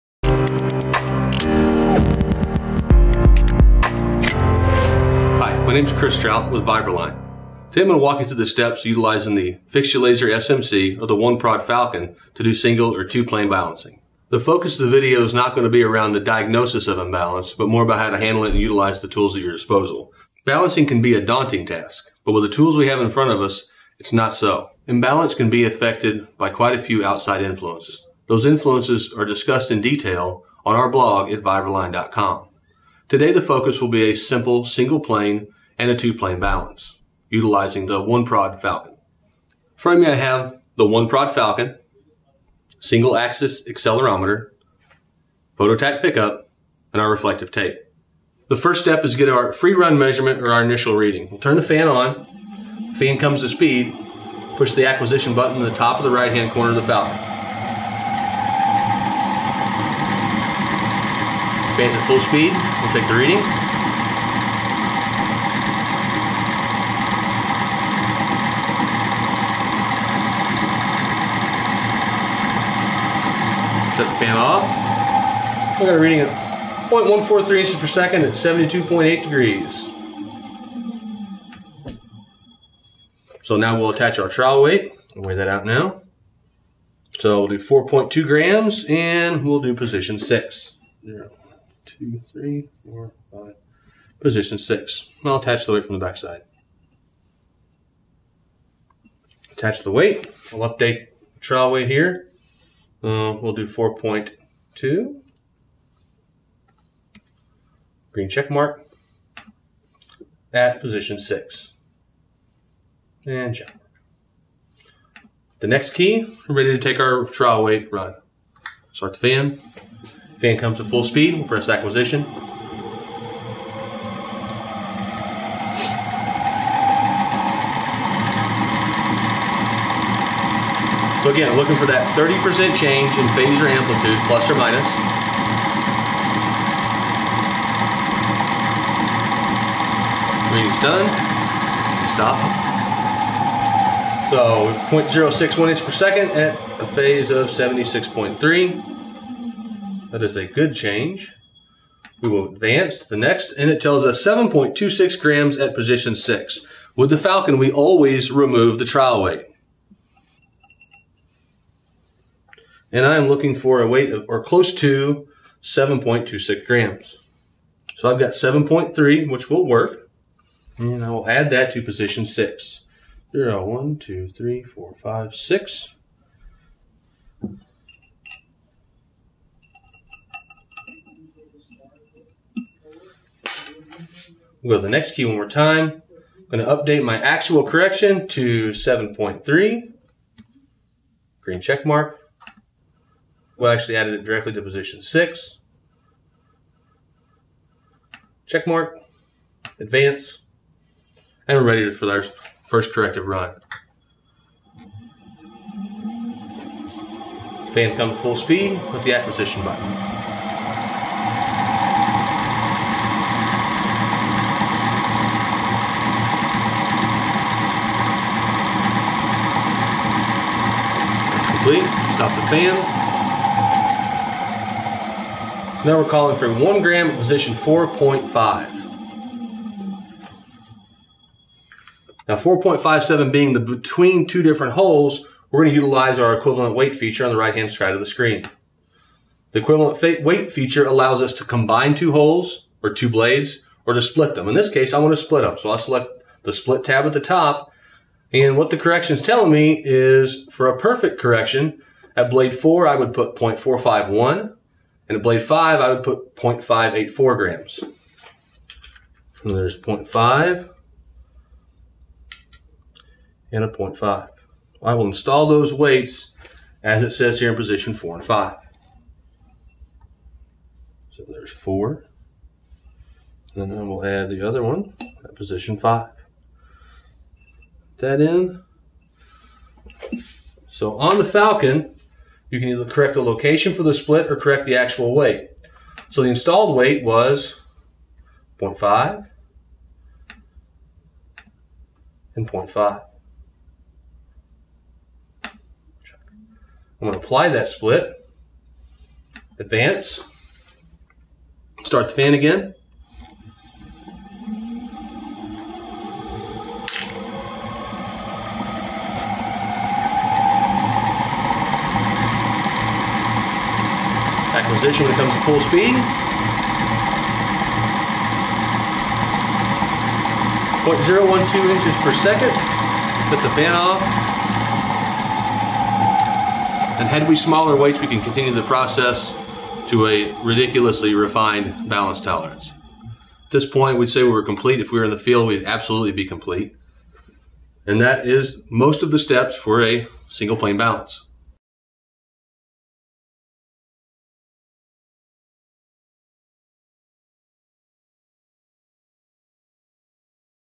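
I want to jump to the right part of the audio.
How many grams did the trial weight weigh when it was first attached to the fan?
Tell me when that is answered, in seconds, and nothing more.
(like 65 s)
87 s.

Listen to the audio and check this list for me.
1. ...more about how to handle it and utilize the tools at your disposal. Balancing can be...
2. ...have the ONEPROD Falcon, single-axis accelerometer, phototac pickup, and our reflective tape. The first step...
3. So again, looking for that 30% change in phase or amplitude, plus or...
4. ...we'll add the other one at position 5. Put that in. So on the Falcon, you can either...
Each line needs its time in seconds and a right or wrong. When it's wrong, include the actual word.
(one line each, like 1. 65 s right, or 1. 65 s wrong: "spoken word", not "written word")
1. 17 s right
2. 40 s right
3. 131 s right
4. 273 s right.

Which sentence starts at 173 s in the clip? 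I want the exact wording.
There are one, two, three, four, five, six.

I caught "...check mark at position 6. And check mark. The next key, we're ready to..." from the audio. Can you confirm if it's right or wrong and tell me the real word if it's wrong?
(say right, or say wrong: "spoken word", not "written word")
right.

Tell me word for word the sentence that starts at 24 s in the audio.
Imbalance can be affected by quite a few outside influences.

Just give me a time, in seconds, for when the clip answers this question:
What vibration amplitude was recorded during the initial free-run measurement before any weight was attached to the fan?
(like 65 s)
76 s.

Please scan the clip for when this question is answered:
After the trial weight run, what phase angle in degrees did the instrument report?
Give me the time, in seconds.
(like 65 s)
147 s.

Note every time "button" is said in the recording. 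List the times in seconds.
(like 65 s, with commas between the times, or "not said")
55 s, 209 s.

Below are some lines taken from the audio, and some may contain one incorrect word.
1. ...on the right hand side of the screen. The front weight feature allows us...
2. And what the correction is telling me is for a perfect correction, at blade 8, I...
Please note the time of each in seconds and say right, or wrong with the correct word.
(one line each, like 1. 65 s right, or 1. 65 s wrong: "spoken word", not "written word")
1. 237 s wrong: "equivalent", not "front"
2. 248 s wrong: "4", not "8".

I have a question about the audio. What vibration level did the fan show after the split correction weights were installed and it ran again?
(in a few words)
0.012 inches per second.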